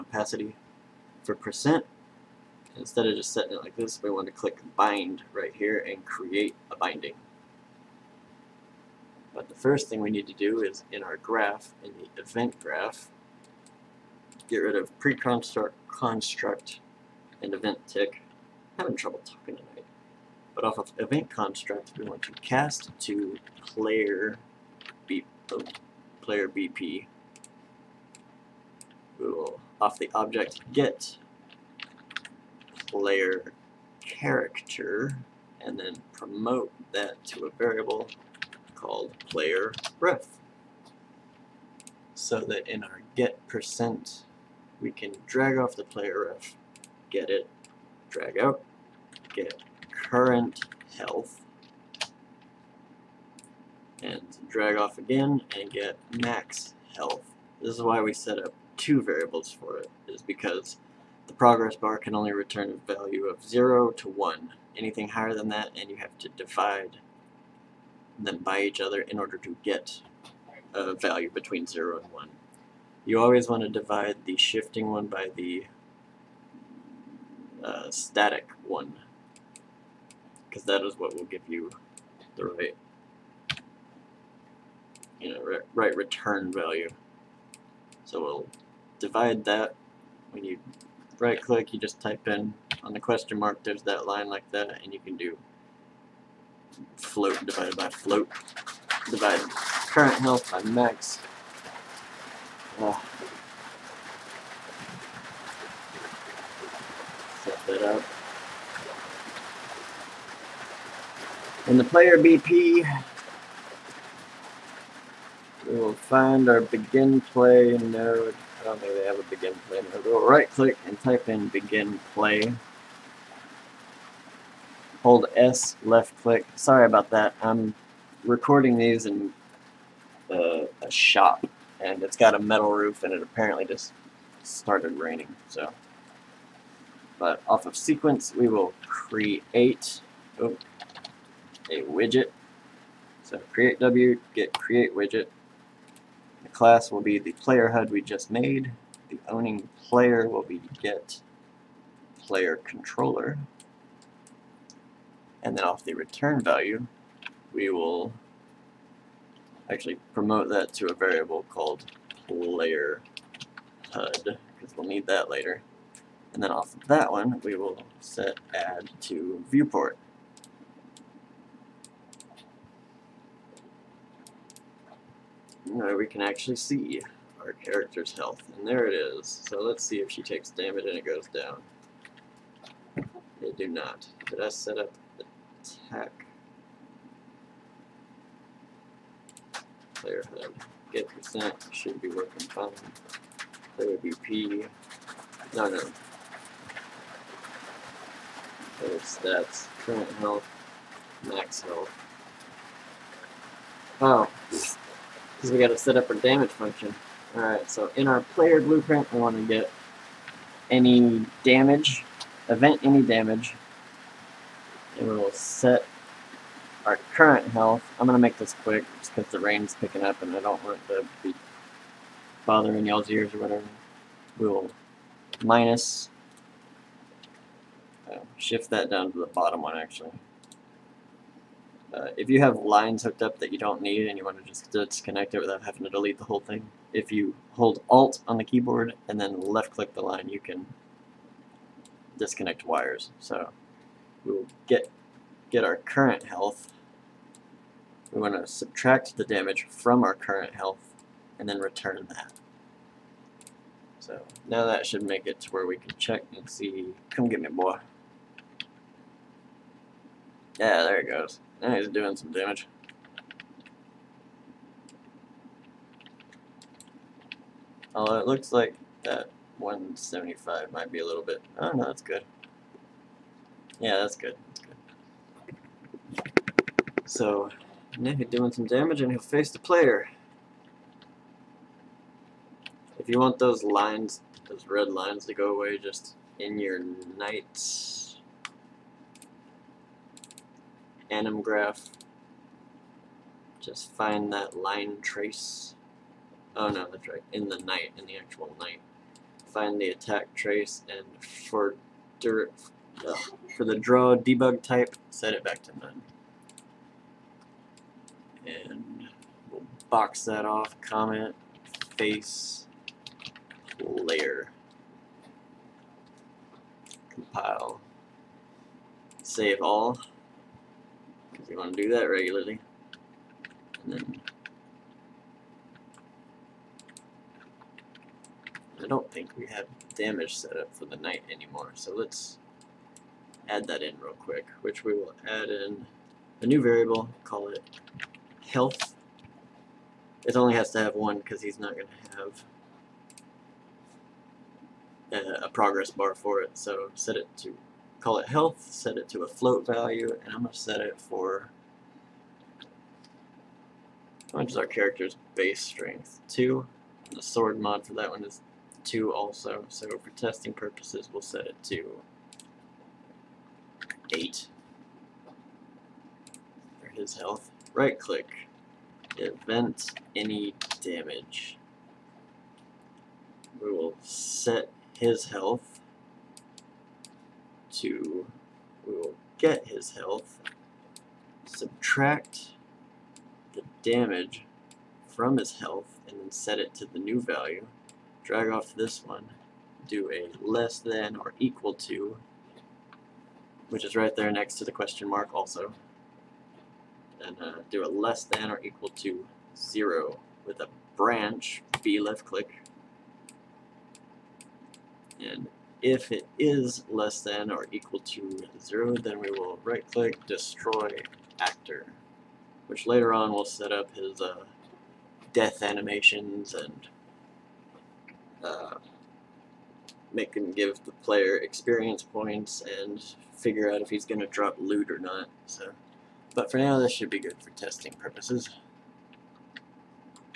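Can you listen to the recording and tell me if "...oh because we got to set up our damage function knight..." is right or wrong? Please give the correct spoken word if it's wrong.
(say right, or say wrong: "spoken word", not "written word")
wrong: "alright", not "knight".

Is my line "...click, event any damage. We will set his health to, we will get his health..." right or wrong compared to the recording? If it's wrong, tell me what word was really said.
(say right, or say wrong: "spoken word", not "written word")
right.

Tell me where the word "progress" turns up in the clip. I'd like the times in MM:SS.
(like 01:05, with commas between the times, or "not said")
01:01, 05:45.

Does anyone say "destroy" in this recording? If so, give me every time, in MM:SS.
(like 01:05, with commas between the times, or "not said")
06:50.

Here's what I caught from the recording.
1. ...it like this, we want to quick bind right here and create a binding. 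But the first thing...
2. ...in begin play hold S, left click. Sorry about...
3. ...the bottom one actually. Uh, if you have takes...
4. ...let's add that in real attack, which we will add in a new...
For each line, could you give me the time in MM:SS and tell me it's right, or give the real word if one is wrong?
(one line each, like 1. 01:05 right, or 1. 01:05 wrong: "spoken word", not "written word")
1. 00:03 wrong: "click", not "quick"
2. 02:01 right
3. 03:49 wrong: "lines", not "takes"
4. 05:31 wrong: "quick", not "attack".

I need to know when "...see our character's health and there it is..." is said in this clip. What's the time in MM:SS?
02:56.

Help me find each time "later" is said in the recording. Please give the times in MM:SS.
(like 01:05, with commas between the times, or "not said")
02:45, 06:52.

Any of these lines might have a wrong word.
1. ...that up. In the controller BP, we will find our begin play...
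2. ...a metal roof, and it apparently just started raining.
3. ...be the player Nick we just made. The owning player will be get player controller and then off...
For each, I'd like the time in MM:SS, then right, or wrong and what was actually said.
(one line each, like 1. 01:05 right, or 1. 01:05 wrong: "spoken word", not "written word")
1. 01:47 wrong: "player", not "controller"
2. 02:12 right
3. 02:27 wrong: "HUD", not "Nick".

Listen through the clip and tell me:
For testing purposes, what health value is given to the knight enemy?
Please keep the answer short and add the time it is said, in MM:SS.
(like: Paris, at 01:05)
8, at 06:04.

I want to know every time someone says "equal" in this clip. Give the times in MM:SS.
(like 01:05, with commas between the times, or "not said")
06:31, 06:38, 06:47.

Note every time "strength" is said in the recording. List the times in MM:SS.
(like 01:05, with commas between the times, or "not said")
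05:55.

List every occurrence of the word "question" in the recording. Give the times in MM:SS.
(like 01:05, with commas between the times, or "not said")
01:32, 06:34.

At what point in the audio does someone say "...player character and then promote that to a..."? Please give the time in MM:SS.
00:32.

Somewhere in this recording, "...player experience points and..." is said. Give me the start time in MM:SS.
07:01.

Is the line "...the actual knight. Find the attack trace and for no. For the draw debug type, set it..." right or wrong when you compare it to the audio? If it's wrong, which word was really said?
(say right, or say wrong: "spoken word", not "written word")
right.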